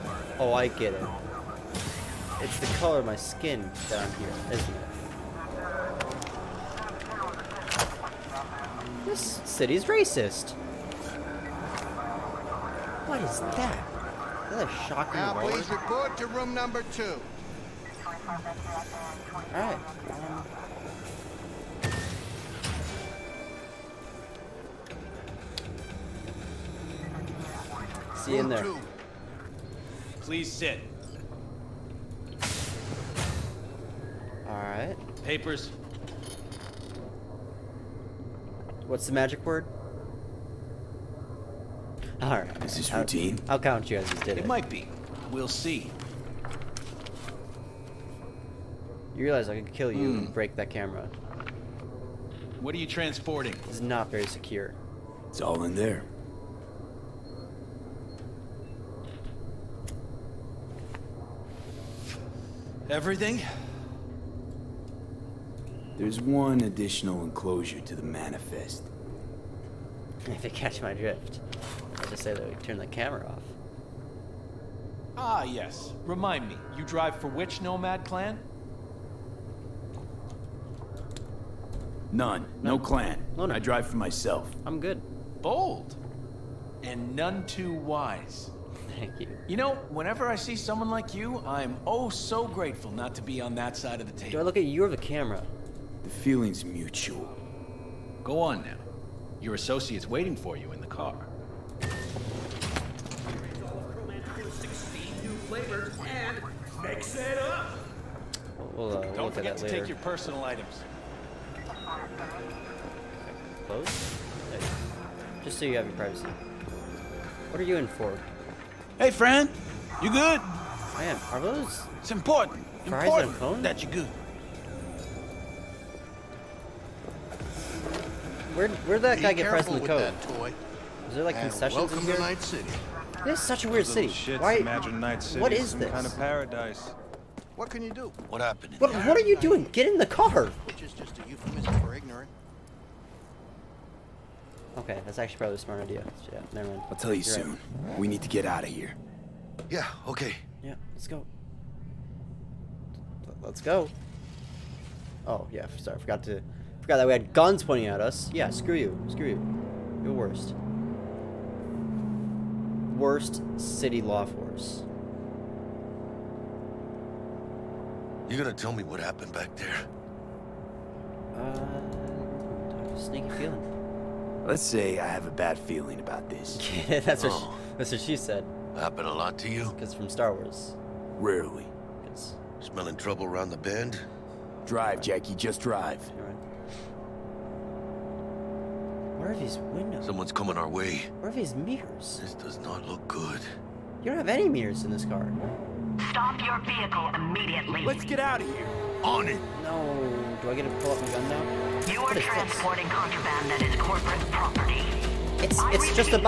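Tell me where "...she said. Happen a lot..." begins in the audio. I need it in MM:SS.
02:58.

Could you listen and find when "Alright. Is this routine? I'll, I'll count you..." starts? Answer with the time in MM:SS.
00:42.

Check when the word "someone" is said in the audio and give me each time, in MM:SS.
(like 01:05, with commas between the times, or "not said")
01:30, 03:10.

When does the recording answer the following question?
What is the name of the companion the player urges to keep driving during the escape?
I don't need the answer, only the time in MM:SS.
03:05.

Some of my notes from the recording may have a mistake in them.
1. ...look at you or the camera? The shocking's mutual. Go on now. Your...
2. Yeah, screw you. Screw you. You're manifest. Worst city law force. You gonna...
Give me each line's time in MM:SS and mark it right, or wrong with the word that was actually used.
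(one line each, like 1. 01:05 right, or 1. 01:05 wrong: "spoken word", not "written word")
1. 01:34 wrong: "feeling", not "shocking"
2. 02:38 wrong: "worst", not "manifest".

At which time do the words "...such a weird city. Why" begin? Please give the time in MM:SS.
02:13.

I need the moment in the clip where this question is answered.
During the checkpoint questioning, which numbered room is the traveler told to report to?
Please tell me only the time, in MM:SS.
00:16.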